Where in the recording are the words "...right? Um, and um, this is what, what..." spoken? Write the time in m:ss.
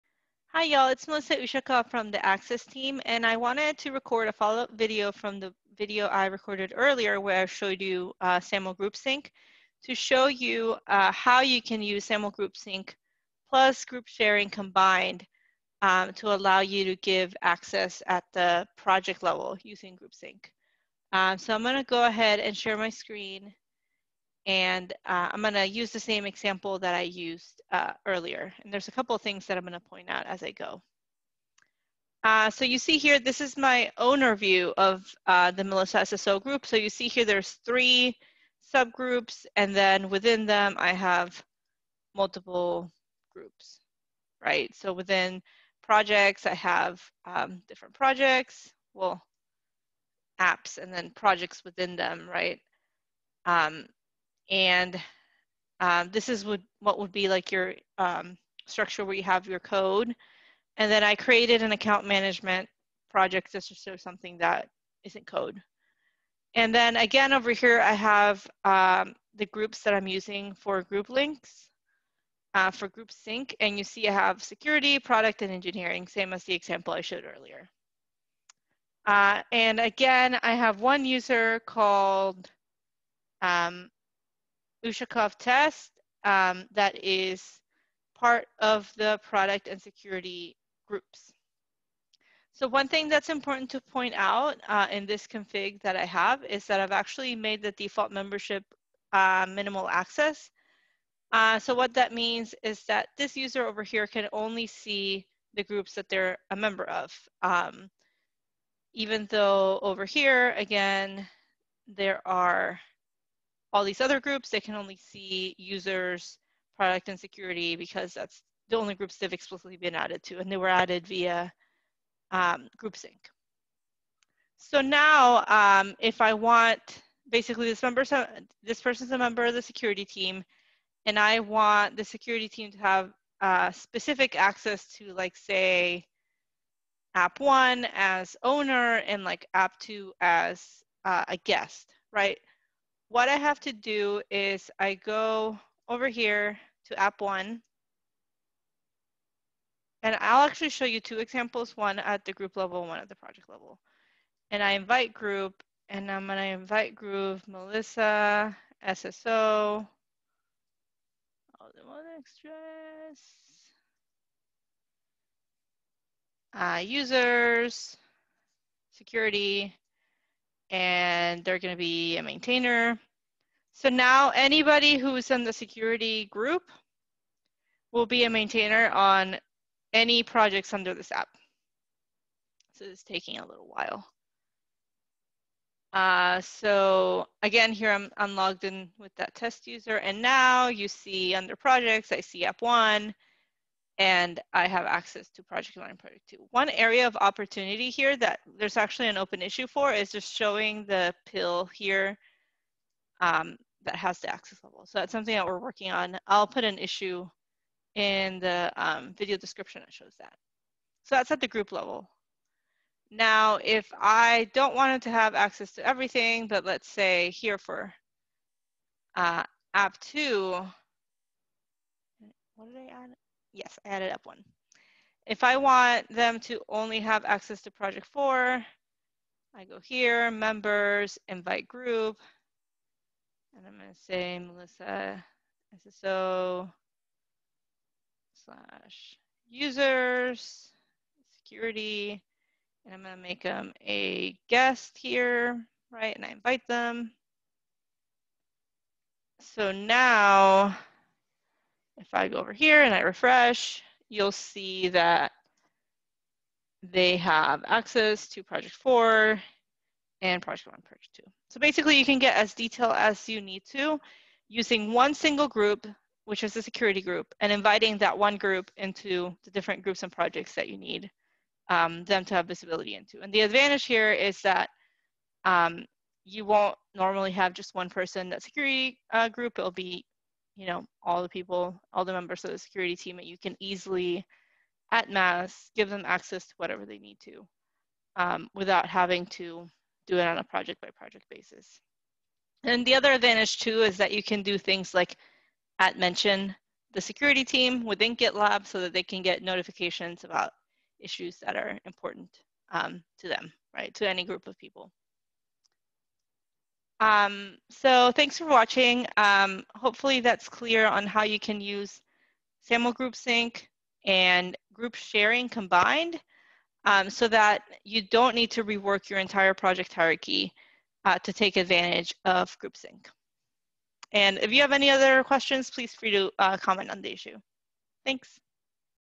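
0:52.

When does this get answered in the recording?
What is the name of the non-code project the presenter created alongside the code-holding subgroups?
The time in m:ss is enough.
1:01.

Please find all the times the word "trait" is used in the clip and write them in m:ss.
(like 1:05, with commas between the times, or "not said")
not said.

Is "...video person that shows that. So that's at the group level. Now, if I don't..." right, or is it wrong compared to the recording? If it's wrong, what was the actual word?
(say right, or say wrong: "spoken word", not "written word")
wrong: "description", not "person".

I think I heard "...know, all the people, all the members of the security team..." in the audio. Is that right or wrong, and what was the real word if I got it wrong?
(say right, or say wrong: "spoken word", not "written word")
right.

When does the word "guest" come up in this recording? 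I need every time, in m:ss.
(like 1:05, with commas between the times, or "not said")
2:21, 4:04.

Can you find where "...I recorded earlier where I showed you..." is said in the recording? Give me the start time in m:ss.
0:06.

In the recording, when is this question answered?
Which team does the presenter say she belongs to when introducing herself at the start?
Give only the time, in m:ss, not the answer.
0:02.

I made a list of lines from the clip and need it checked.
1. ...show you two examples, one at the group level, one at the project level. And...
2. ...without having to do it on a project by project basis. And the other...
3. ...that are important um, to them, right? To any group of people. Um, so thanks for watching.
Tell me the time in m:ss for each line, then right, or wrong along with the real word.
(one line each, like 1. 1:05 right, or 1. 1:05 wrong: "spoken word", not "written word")
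1. 2:30 right
2. 4:48 right
3. 5:01 right.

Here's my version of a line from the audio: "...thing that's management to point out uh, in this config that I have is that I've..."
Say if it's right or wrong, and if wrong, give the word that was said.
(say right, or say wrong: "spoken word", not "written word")
wrong: "important", not "management".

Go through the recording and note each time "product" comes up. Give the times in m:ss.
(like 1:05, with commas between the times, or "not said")
1:14, 1:29, 1:56.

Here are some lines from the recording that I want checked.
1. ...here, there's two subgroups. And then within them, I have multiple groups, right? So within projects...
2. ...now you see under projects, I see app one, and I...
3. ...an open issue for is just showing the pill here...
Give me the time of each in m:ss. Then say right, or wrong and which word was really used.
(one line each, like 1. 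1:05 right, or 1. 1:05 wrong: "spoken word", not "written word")
1. 0:37 wrong: "three", not "two"
2. 3:10 right
3. 3:19 right.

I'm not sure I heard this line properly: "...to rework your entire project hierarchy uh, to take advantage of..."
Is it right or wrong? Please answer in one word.
right.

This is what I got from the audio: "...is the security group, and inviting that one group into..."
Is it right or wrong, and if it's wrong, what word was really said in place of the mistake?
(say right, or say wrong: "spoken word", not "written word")
right.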